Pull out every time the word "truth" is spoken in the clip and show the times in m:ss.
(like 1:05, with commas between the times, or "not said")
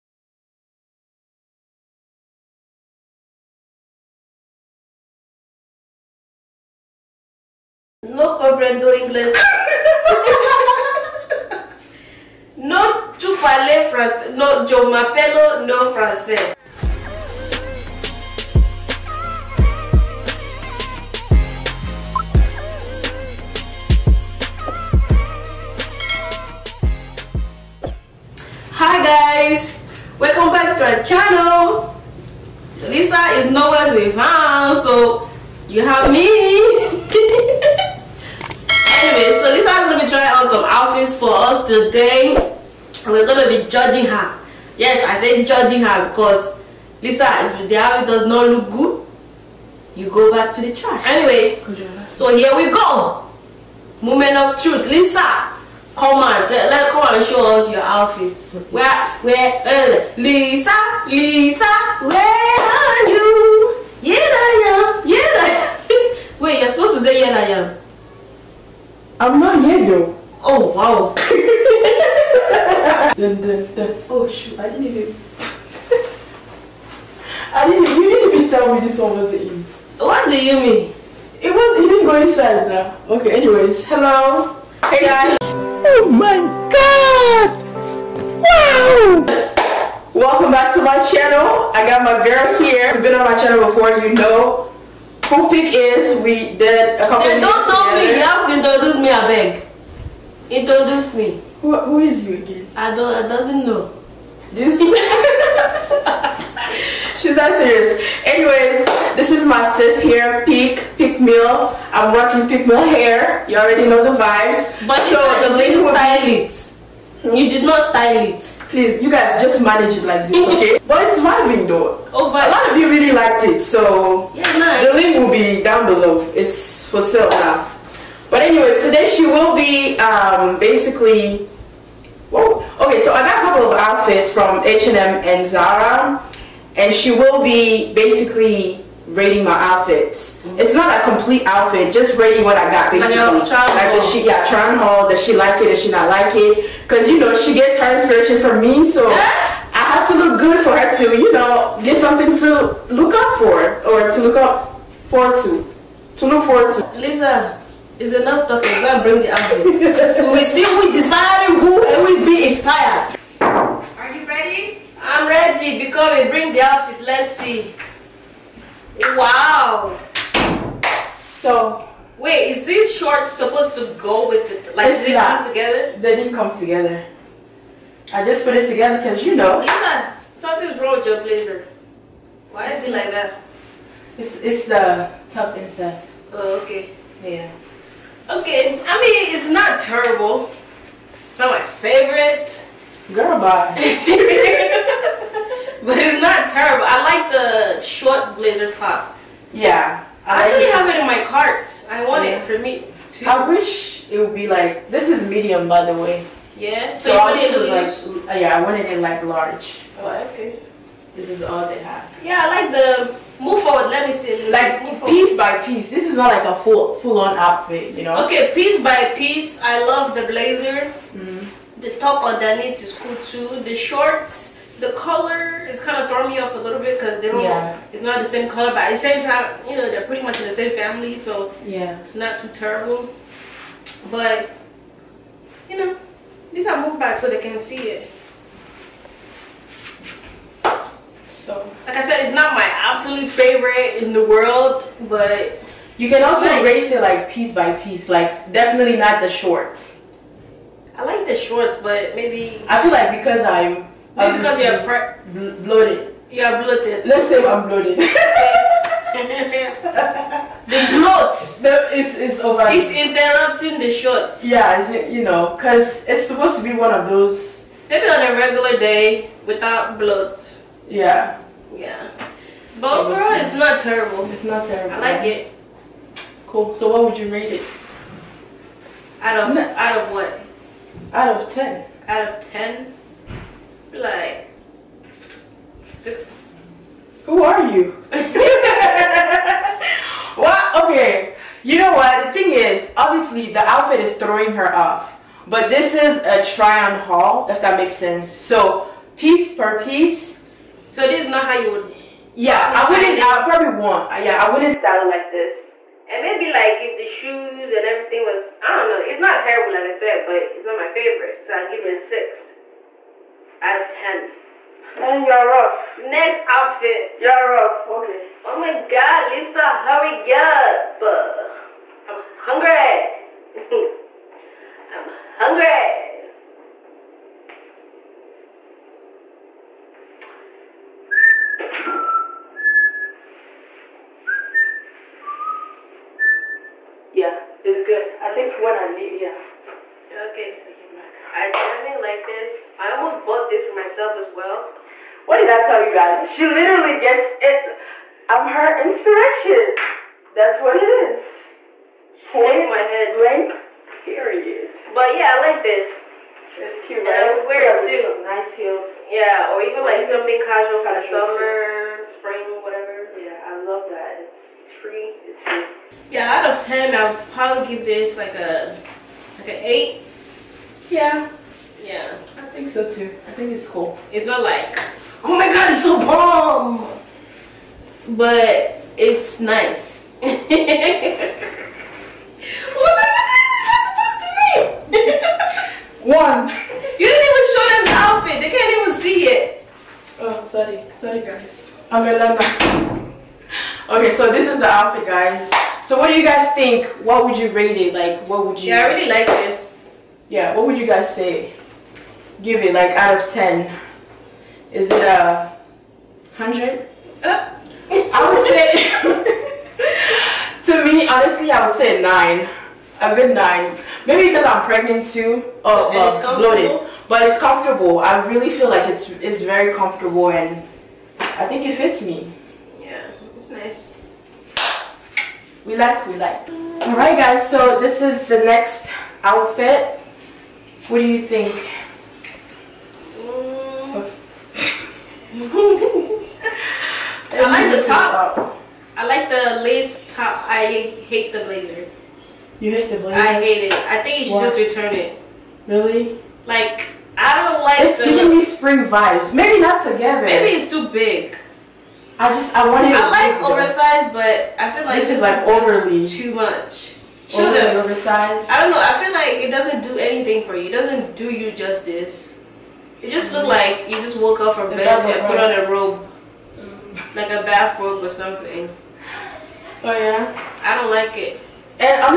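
0:54.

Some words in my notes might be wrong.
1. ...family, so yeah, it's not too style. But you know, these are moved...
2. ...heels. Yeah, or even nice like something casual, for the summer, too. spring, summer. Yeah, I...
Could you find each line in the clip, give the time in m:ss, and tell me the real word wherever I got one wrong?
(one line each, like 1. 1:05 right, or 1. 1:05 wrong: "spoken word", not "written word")
1. 3:50 wrong: "terrible", not "style"
2. 5:58 wrong: "whatever", not "summer".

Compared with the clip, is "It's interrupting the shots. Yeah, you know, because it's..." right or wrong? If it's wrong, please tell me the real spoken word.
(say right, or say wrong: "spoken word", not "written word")
right.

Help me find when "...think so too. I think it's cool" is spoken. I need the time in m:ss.
6:12.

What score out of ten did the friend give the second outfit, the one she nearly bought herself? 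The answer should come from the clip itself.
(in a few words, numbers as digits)
8.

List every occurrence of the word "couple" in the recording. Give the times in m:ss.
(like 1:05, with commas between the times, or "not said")
1:37, 2:13.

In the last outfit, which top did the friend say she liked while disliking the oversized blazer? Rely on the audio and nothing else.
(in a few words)
lace top.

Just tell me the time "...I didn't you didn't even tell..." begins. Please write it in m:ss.
1:17.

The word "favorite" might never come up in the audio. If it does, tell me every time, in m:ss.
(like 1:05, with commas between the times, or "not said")
3:11, 4:03, 5:10.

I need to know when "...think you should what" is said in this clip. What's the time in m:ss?
7:24.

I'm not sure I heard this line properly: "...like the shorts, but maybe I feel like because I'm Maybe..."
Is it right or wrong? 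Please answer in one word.
right.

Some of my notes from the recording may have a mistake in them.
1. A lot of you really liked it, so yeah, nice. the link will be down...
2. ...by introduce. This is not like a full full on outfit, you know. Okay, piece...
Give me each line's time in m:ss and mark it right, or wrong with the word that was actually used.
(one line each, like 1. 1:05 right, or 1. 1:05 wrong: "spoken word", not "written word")
1. 2:02 right
2. 3:35 wrong: "piece", not "introduce".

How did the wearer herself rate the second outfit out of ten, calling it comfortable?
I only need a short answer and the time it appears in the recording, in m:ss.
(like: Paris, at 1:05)
9, at 6:53.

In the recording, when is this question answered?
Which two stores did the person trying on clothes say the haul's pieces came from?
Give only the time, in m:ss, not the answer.
2:14.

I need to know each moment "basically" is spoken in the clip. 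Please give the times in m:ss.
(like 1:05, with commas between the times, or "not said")
2:10, 2:17, 2:22.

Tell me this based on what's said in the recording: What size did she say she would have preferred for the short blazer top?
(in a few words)
large.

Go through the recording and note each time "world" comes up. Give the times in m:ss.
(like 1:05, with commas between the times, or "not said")
4:04.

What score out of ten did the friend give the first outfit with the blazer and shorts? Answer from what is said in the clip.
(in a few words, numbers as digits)
6.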